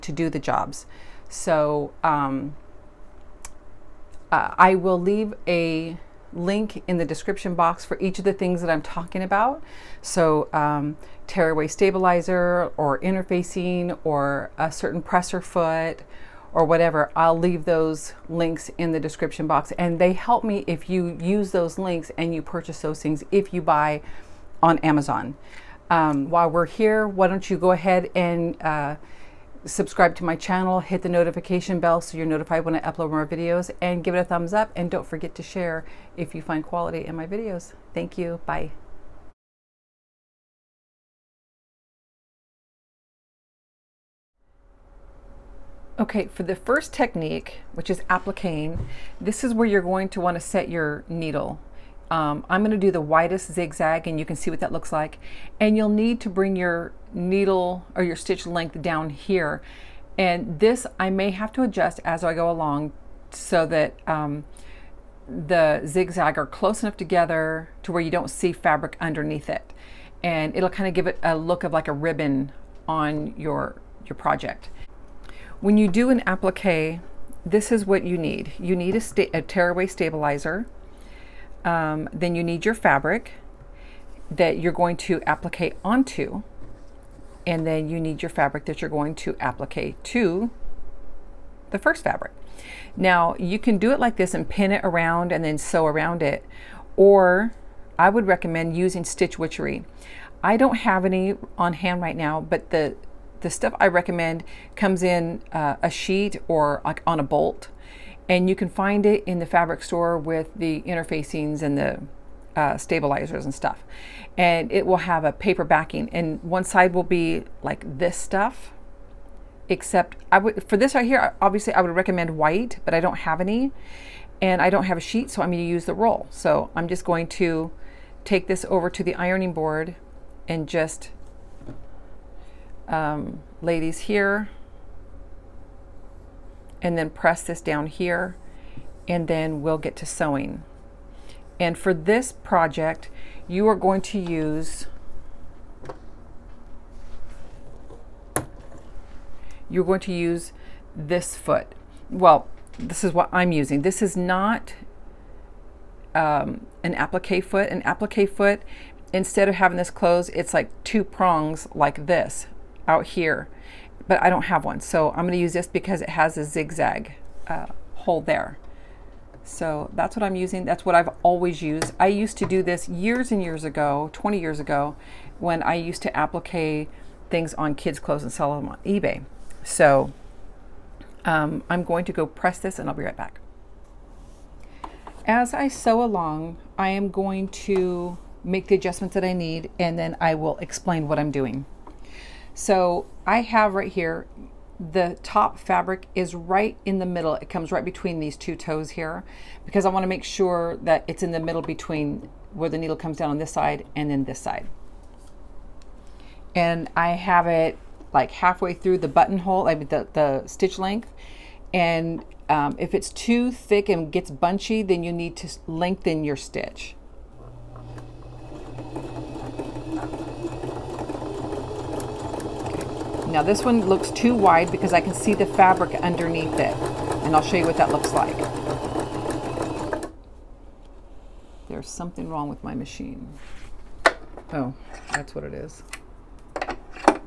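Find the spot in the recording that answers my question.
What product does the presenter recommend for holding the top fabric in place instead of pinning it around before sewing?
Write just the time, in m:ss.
1:39.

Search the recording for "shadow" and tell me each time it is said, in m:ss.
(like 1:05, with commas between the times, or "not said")
not said.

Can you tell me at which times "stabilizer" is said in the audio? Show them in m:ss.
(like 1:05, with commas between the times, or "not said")
0:11, 1:19, 1:52.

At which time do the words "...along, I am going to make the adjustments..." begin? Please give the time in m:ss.
3:06.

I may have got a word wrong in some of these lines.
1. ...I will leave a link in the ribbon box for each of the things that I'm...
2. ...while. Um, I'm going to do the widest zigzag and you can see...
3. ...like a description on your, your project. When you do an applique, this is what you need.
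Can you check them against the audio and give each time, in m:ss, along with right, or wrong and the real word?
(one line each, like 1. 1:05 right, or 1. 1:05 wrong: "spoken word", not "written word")
1. 0:04 wrong: "description", not "ribbon"
2. 0:51 wrong: "needle", not "while"
3. 1:11 wrong: "ribbon", not "description".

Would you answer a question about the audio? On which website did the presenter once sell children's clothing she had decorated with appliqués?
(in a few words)
eBay.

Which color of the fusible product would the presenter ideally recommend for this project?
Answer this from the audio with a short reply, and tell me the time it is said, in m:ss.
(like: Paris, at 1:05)
white, at 2:02.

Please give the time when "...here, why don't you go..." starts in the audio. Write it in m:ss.
0:26.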